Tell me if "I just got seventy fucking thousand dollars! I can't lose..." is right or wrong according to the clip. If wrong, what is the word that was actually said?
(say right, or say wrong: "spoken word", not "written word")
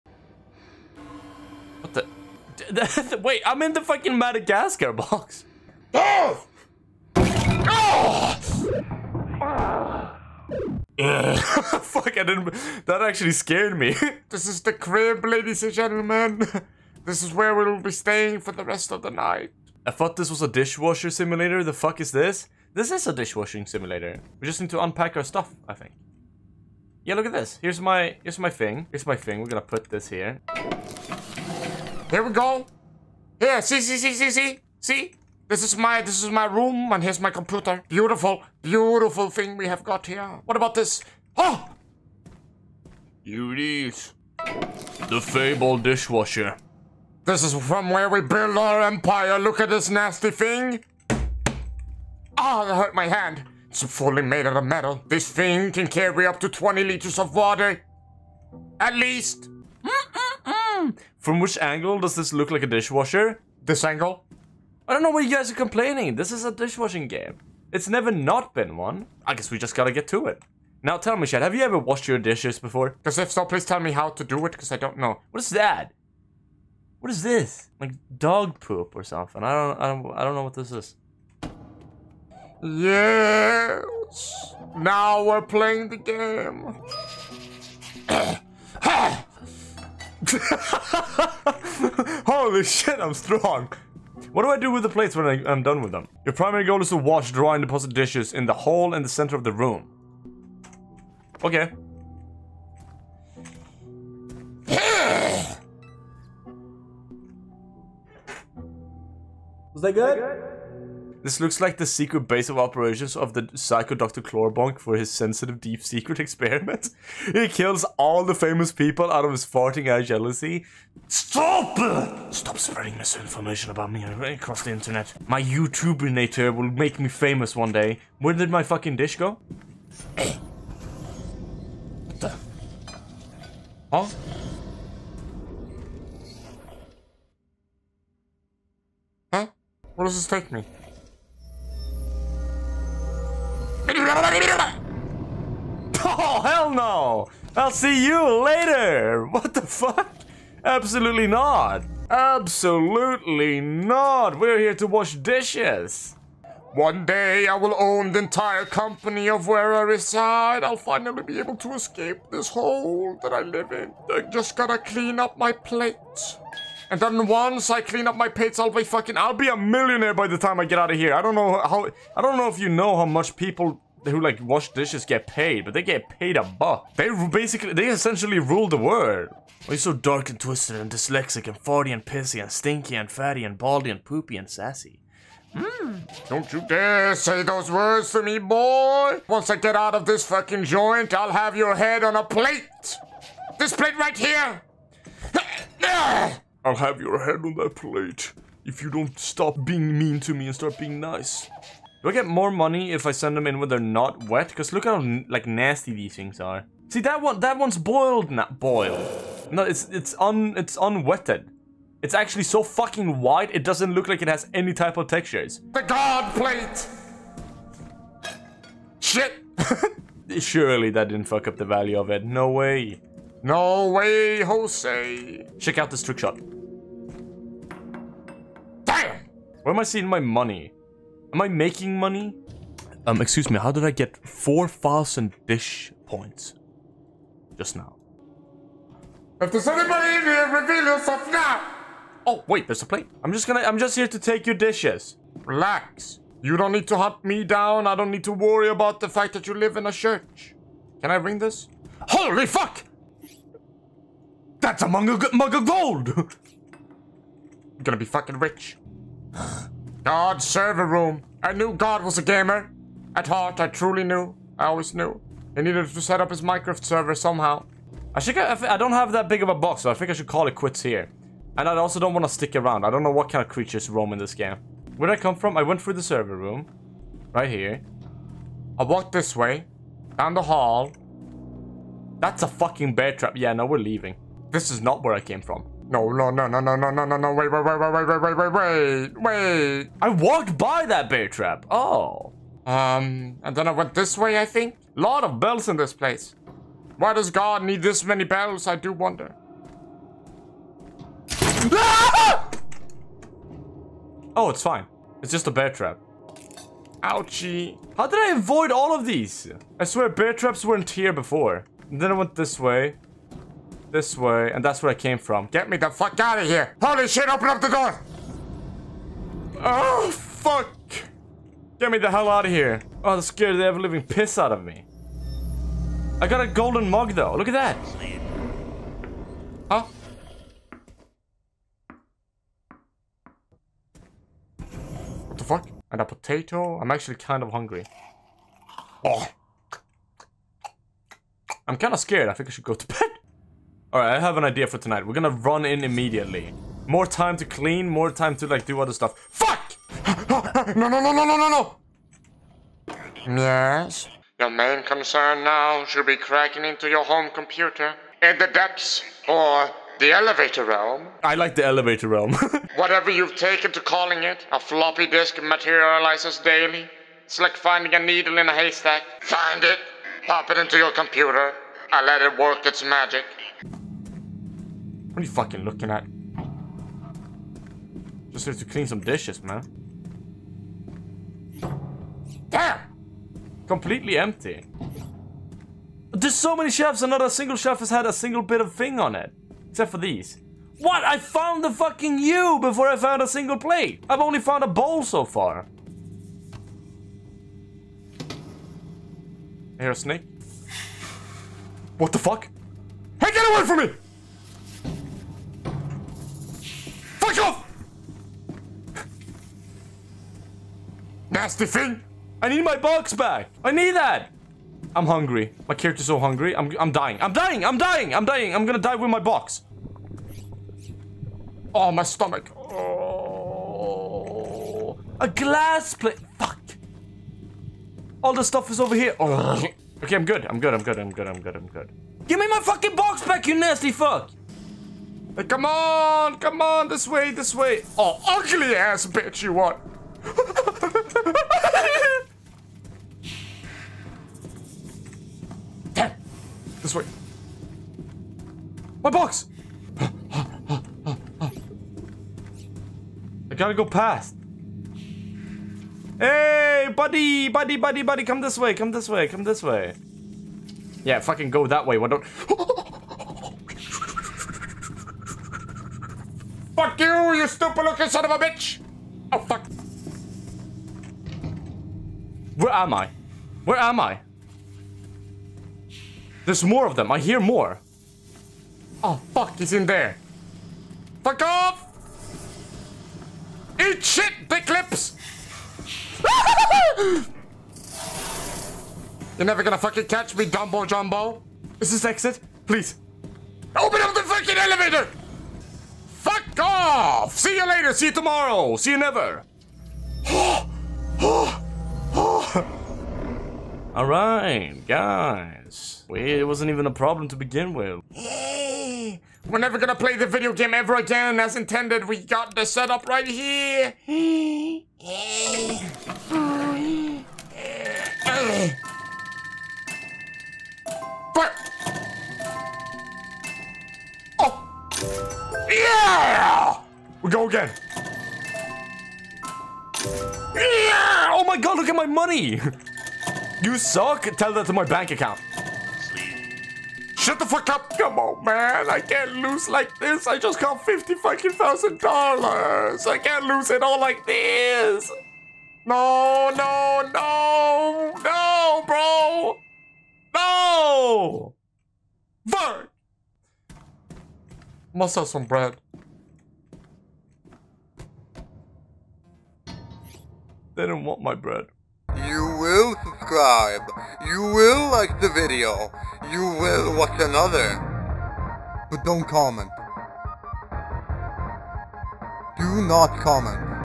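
wrong: "fifty", not "seventy".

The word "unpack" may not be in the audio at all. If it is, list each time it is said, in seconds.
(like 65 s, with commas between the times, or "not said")
24 s.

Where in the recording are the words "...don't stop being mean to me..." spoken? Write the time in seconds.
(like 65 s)
198 s.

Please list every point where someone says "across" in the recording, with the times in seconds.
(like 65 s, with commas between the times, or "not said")
124 s.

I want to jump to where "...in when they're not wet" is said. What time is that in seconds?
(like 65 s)
203 s.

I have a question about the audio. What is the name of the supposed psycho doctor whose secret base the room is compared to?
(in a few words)
Dr. Clorbonk.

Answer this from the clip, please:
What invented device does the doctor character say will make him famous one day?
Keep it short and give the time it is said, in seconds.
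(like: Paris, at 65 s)
YouTubinator, at 125 s.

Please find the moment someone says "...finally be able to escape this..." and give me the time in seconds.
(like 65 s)
160 s.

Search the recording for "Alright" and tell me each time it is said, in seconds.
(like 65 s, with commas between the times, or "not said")
343 s, 503 s.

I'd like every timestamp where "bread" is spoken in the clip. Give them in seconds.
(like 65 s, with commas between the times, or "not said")
555 s, 561 s.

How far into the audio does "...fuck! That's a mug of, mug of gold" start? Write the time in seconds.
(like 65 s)
252 s.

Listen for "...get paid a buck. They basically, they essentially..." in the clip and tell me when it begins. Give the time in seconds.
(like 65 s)
175 s.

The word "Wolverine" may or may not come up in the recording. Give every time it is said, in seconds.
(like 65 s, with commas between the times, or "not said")
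not said.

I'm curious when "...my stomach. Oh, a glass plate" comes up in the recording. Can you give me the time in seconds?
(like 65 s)
421 s.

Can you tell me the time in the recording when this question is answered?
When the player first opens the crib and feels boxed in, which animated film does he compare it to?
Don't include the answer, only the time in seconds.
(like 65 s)
4 s.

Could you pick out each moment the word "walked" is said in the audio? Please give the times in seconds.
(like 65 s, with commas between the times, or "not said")
278 s, 290 s.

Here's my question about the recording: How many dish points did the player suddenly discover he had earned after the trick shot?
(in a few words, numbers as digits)
4000.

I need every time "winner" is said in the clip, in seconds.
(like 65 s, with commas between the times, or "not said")
not said.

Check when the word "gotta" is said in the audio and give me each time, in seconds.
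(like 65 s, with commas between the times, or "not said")
69 s, 164 s, 453 s.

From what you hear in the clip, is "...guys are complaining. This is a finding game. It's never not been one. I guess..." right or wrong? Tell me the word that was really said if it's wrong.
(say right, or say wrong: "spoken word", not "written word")
wrong: "dishwashing", not "finding".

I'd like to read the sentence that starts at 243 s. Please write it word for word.
I'm just gonna- I'm just here to take your dishes.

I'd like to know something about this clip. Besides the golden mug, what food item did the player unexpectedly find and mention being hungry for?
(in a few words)
Potato.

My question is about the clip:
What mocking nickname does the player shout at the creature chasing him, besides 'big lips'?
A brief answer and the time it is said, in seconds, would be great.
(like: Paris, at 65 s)
Dumbo Jumbo, at 490 s.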